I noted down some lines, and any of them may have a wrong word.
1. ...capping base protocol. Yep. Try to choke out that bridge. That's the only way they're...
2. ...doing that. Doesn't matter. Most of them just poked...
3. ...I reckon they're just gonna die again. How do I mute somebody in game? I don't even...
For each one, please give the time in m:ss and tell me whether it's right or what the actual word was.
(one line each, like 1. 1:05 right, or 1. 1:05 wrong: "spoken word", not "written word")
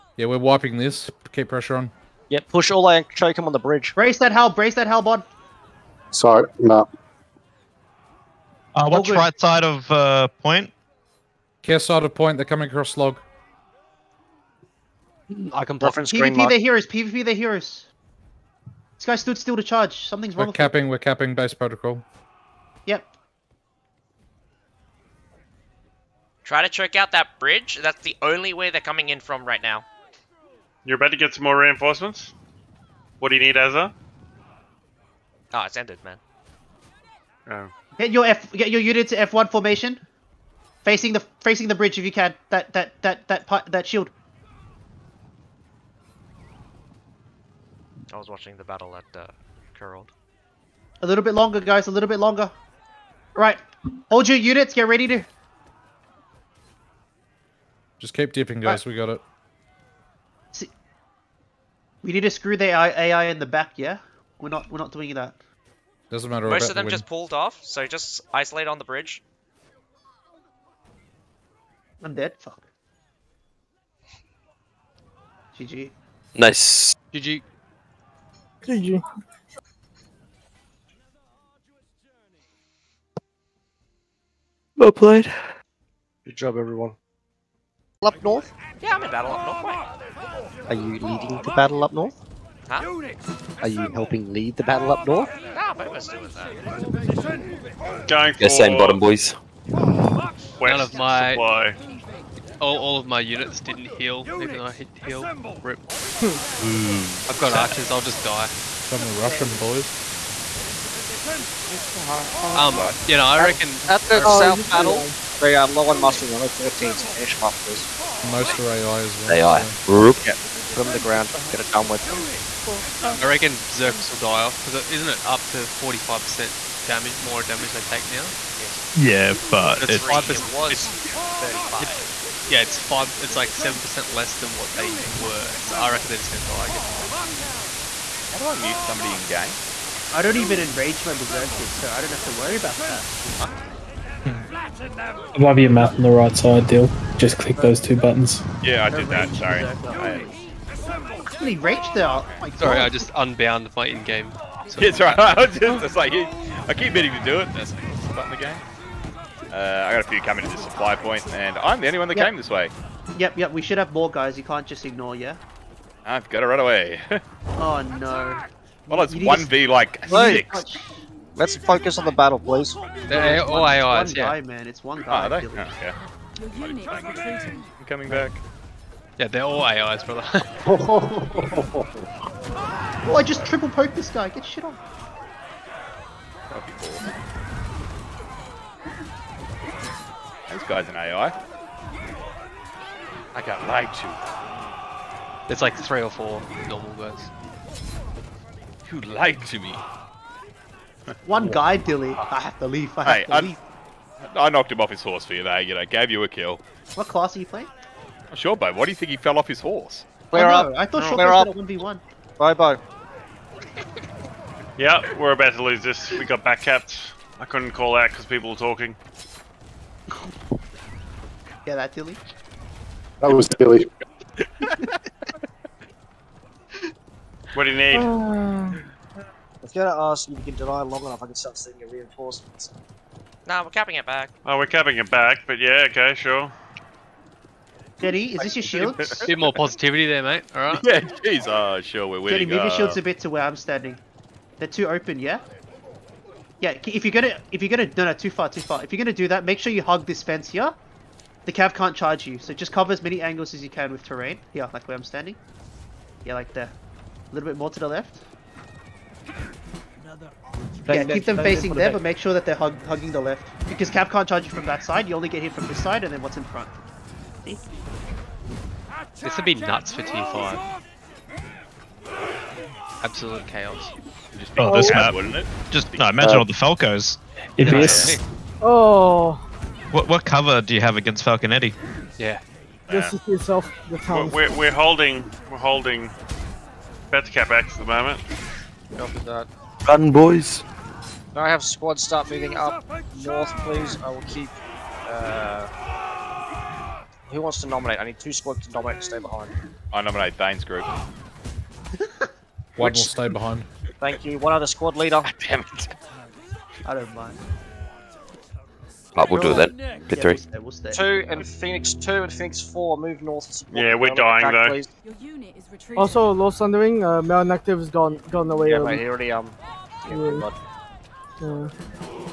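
1. 0:20 right
2. 1:04 wrong: "pulled", not "poked"
3. 2:15 right.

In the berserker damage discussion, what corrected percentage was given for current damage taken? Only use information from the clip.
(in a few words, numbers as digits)
35%.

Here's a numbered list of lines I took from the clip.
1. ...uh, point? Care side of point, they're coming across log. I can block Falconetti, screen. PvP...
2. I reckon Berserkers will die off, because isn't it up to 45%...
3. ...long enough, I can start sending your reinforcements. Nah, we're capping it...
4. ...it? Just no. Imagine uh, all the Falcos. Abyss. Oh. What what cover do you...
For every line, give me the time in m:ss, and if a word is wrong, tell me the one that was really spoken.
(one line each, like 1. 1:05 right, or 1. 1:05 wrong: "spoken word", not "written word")
1. 0:09 wrong: "PvP", not "Falconetti"
2. 2:03 right
3. 3:50 right
4. 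4:35 right.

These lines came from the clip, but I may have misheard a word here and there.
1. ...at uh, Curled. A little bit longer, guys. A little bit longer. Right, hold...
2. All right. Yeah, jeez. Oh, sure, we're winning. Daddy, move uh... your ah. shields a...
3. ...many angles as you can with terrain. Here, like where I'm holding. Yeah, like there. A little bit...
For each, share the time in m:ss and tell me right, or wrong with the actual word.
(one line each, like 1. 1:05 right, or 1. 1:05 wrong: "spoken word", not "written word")
1. 0:48 right
2. 4:00 right
3. 4:13 wrong: "standing", not "holding".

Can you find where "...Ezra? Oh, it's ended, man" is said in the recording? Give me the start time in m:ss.
0:33.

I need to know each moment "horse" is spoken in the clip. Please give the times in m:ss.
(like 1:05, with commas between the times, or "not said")
3:25, 3:29.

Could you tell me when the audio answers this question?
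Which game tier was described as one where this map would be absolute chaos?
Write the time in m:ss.
4:30.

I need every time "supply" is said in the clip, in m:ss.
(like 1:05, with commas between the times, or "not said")
1:41, 2:40.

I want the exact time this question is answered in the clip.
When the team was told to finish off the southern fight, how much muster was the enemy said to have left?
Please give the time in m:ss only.
1:56.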